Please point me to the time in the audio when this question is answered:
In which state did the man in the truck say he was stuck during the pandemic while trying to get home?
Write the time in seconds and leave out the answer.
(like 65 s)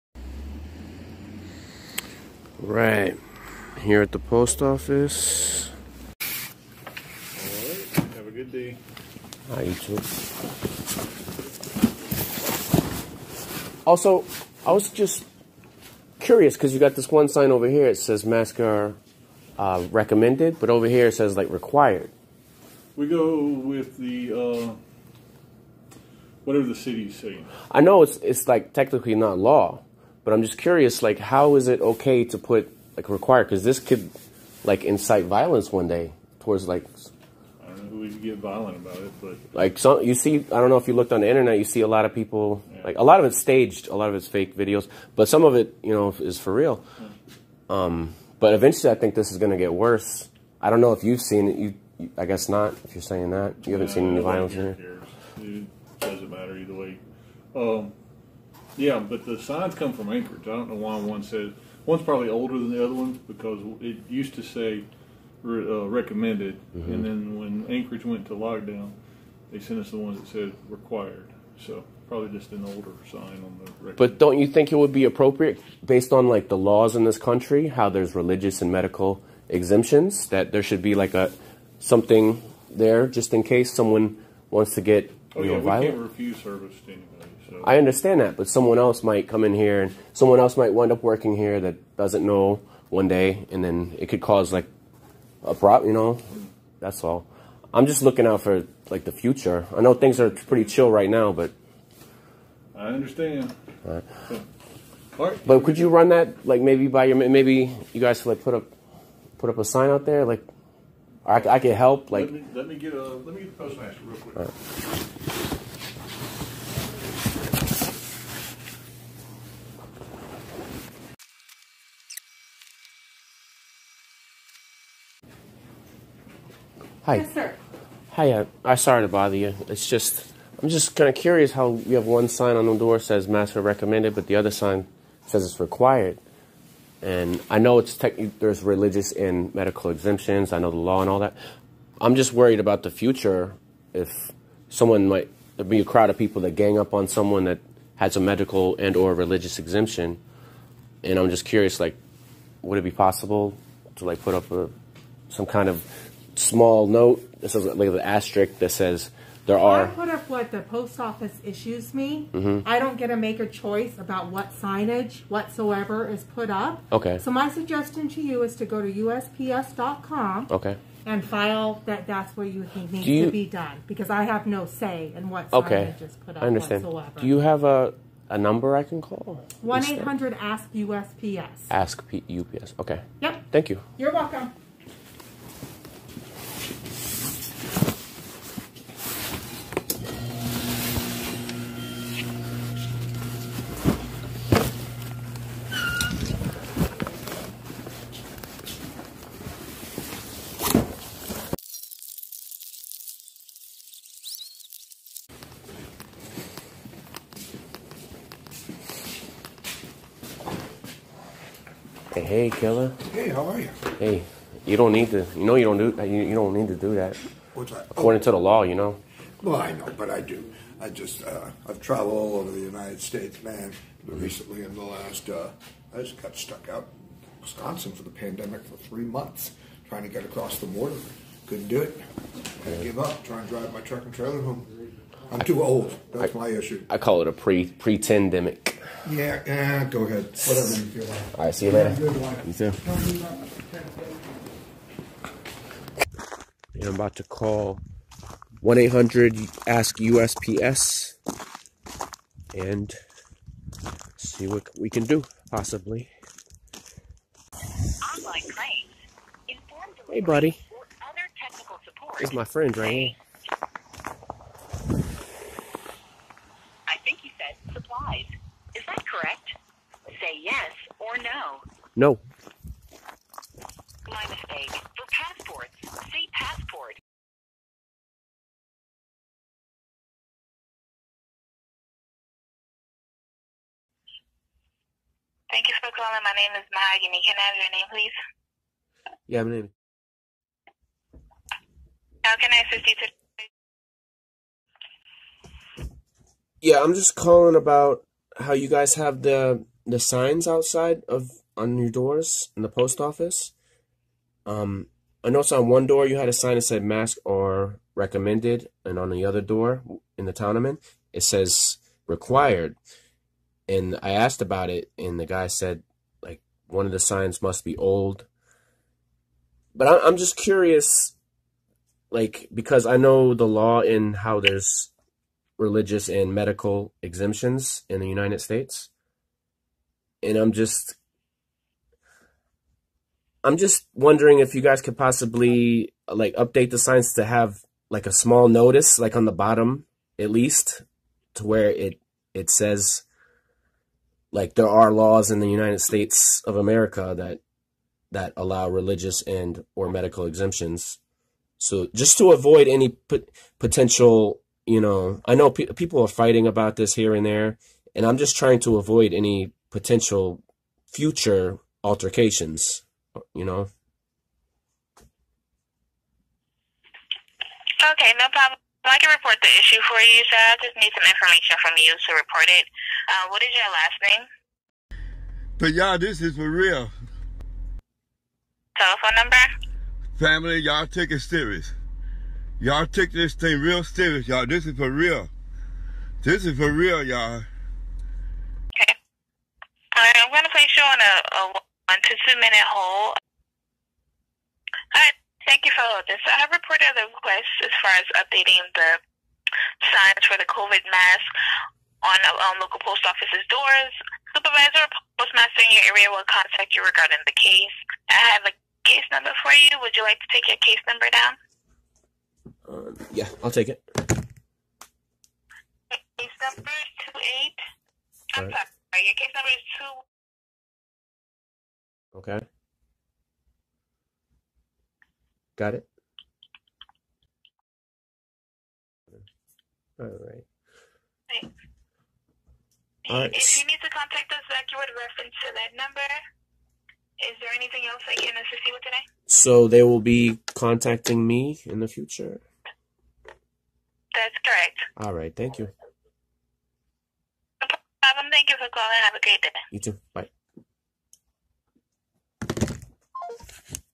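227 s.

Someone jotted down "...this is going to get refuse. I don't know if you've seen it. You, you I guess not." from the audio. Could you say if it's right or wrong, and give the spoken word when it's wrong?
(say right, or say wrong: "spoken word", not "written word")
wrong: "worse", not "refuse".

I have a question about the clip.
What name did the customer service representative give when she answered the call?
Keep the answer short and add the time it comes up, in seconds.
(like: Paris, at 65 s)
Maggie, at 286 s.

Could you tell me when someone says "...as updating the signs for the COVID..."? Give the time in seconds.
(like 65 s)
397 s.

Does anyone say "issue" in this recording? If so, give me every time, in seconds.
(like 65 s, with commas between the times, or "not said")
161 s, 236 s, 369 s.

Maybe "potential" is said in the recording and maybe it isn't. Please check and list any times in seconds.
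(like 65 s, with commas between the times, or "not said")
353 s, 359 s.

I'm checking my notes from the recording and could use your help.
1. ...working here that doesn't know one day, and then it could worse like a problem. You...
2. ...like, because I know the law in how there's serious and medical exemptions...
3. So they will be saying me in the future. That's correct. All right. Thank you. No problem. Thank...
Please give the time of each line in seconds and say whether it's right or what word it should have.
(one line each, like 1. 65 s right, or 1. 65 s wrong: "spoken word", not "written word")
1. 91 s wrong: "cause", not "worse"
2. 322 s wrong: "religious", not "serious"
3. 439 s wrong: "contacting", not "saying".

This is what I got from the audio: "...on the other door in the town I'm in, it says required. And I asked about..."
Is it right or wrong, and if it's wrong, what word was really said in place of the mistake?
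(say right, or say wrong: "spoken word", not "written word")
right.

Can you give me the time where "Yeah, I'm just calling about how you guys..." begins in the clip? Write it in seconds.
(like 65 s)
296 s.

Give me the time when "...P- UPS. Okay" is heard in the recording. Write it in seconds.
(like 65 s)
182 s.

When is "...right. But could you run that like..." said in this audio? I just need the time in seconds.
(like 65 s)
105 s.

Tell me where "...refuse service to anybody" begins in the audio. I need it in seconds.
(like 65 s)
86 s.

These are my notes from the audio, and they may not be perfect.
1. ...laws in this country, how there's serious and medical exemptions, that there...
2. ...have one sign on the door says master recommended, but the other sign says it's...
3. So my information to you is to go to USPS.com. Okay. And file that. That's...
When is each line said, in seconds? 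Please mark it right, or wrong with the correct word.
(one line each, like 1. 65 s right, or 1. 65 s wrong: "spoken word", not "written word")
1. 76 s wrong: "religious", not "serious"
2. 131 s right
3. 167 s wrong: "suggestion", not "information".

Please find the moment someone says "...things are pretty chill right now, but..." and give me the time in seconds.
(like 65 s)
99 s.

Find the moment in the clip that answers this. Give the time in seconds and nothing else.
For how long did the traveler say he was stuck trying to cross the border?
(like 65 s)
228 s.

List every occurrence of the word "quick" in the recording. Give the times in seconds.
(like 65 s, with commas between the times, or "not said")
114 s.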